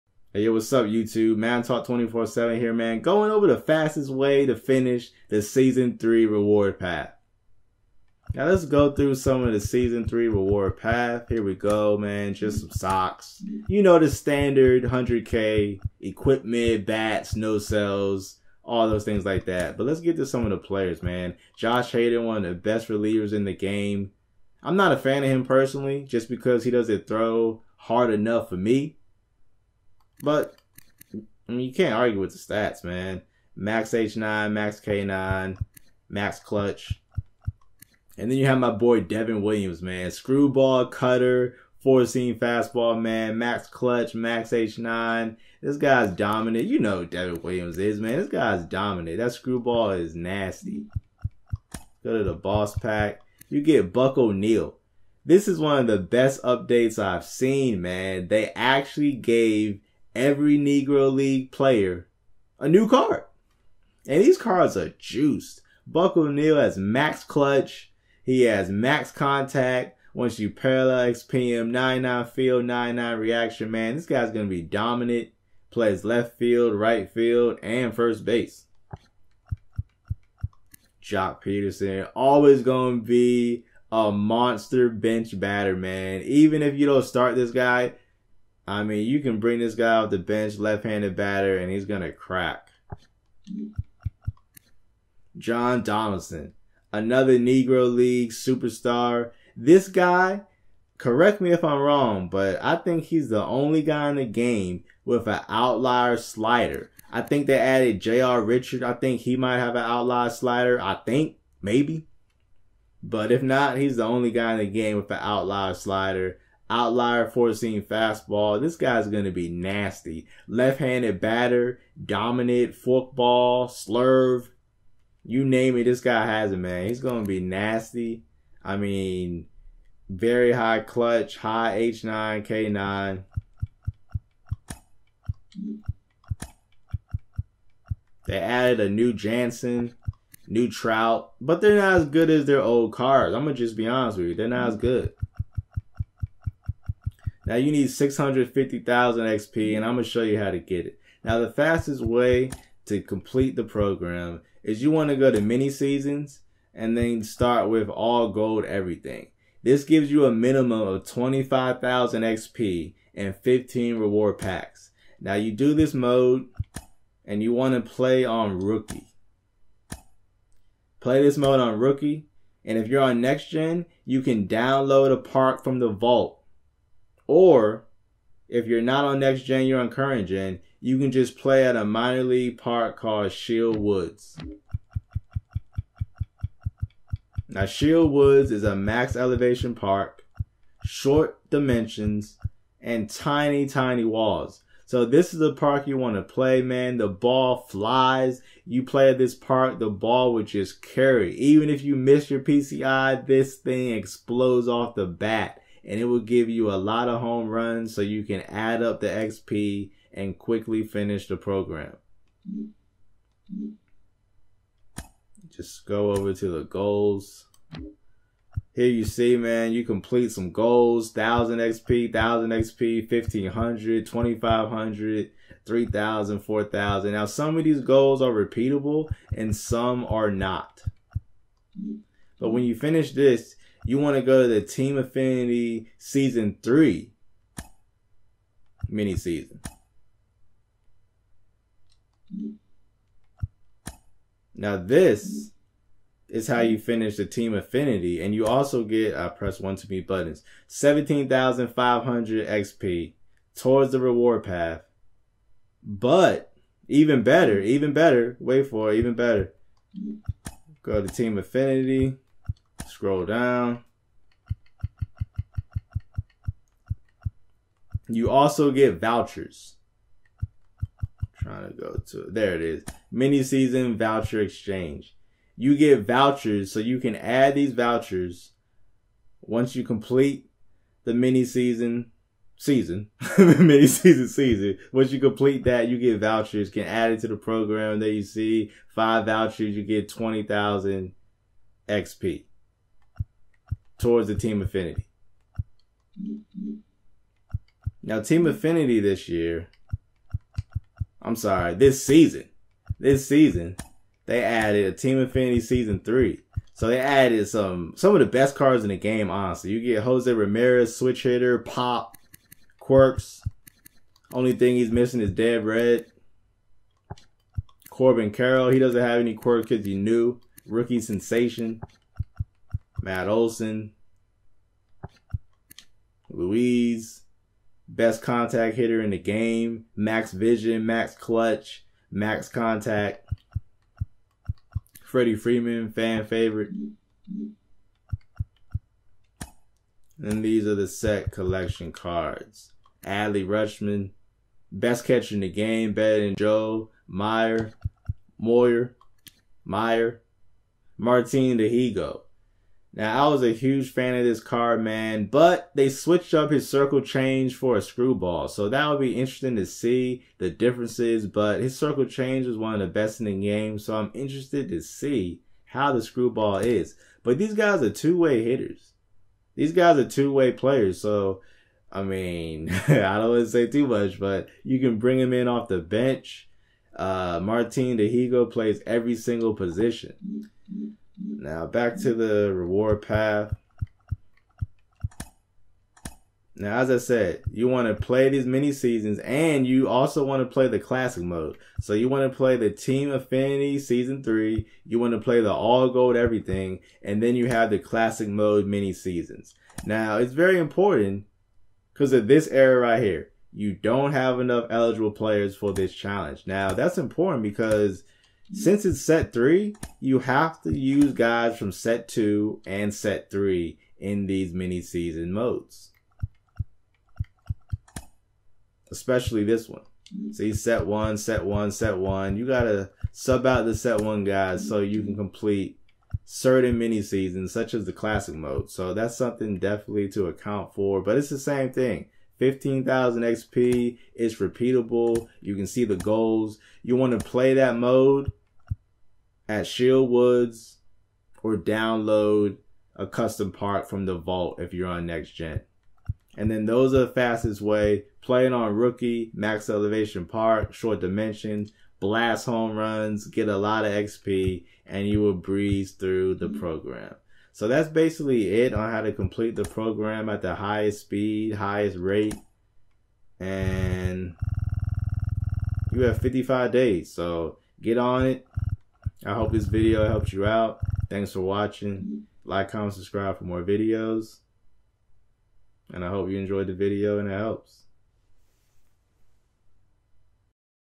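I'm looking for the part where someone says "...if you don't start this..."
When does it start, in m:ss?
1:26.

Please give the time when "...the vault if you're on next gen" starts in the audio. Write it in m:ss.
7:24.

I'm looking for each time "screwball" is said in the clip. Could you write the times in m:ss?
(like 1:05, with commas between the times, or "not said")
0:40, 0:49, 5:57, 6:06.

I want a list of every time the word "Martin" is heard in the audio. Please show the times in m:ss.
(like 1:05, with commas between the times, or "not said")
5:50, 6:17.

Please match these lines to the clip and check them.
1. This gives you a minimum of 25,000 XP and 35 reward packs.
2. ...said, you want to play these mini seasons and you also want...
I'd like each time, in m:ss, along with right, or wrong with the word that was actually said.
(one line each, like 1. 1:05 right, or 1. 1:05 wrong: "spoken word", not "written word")
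1. 2:39 wrong: "15", not "35"
2. 6:26 right.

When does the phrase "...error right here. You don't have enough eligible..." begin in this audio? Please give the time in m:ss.
6:42.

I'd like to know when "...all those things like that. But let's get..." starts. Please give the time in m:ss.
0:18.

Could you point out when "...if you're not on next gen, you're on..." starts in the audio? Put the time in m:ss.
2:58.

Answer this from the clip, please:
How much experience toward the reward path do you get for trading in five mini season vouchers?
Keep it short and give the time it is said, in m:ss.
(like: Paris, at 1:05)
20000 XP, at 4:50.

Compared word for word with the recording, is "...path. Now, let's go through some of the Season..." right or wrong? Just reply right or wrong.
right.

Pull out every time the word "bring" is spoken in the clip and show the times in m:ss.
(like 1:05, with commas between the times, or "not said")
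1:29, 6:14.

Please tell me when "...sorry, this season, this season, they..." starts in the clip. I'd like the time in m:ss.
5:01.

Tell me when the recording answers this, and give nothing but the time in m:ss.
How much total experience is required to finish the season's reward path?
2:27.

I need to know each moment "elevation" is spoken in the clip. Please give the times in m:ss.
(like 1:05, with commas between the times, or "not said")
3:09, 7:29.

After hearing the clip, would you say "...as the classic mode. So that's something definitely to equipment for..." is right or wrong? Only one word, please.
wrong.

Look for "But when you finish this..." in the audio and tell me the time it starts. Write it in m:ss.
3:52.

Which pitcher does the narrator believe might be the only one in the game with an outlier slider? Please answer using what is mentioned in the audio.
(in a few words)
John Donaldson.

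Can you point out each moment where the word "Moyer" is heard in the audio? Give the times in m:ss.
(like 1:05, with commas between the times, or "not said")
5:48.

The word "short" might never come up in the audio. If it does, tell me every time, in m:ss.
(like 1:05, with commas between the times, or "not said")
3:10, 7:30.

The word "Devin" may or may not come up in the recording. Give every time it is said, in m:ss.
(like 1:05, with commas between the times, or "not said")
0:39, 0:47.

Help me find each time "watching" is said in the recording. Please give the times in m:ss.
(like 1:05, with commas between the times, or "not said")
7:51.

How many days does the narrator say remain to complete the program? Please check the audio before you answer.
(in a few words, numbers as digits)
55.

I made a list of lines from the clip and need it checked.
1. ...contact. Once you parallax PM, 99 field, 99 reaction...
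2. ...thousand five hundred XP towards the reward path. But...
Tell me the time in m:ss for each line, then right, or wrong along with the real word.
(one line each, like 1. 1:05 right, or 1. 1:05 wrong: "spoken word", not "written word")
1. 1:09 right
2. 4:11 right.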